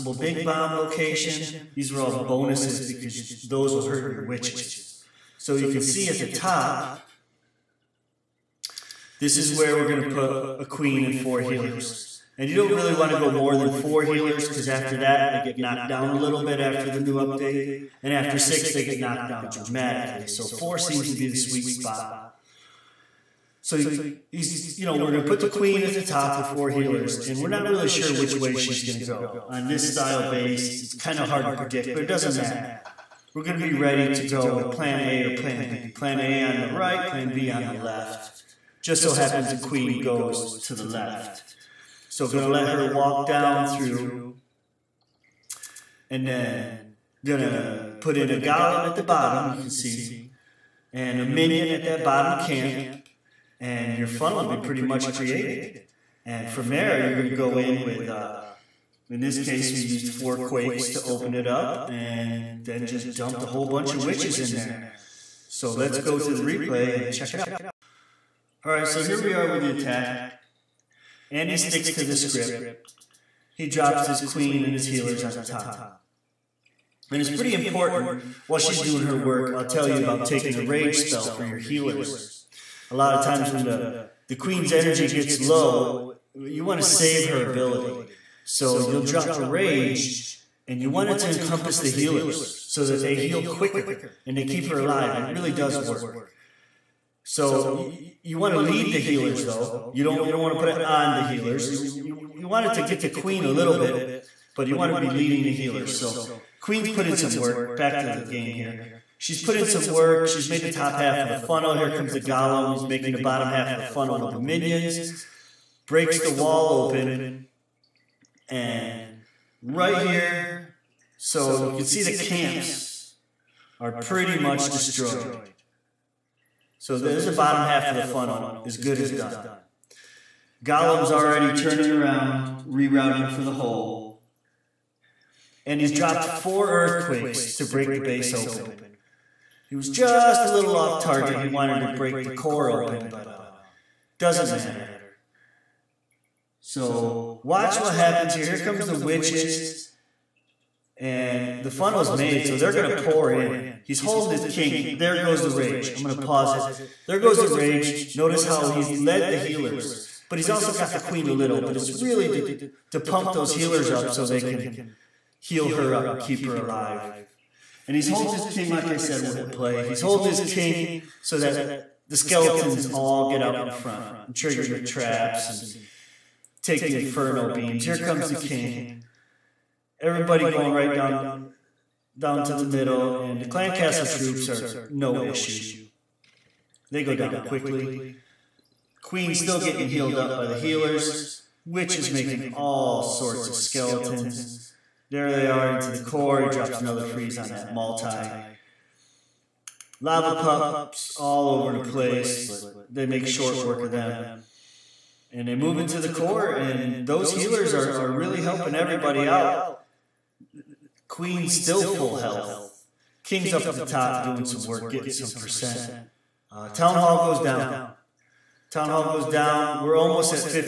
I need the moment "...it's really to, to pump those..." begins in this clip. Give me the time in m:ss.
2:41.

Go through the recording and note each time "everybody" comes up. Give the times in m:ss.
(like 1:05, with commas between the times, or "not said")
2:59, 3:28.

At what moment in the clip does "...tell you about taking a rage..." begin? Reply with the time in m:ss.
1:19.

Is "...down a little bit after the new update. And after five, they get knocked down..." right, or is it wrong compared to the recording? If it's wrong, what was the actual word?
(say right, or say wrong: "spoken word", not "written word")
wrong: "six", not "five".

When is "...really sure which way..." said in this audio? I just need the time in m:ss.
0:27.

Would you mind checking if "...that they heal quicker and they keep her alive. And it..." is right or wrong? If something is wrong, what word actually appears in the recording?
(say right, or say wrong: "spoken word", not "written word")
right.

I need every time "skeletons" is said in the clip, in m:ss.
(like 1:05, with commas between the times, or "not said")
2:52, 3:13.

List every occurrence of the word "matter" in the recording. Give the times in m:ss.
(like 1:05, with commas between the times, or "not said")
0:32, 2:24.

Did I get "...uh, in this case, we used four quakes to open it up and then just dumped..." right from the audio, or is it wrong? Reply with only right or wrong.
right.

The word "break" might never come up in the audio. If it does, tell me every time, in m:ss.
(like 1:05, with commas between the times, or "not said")
1:55, 2:17, 2:21.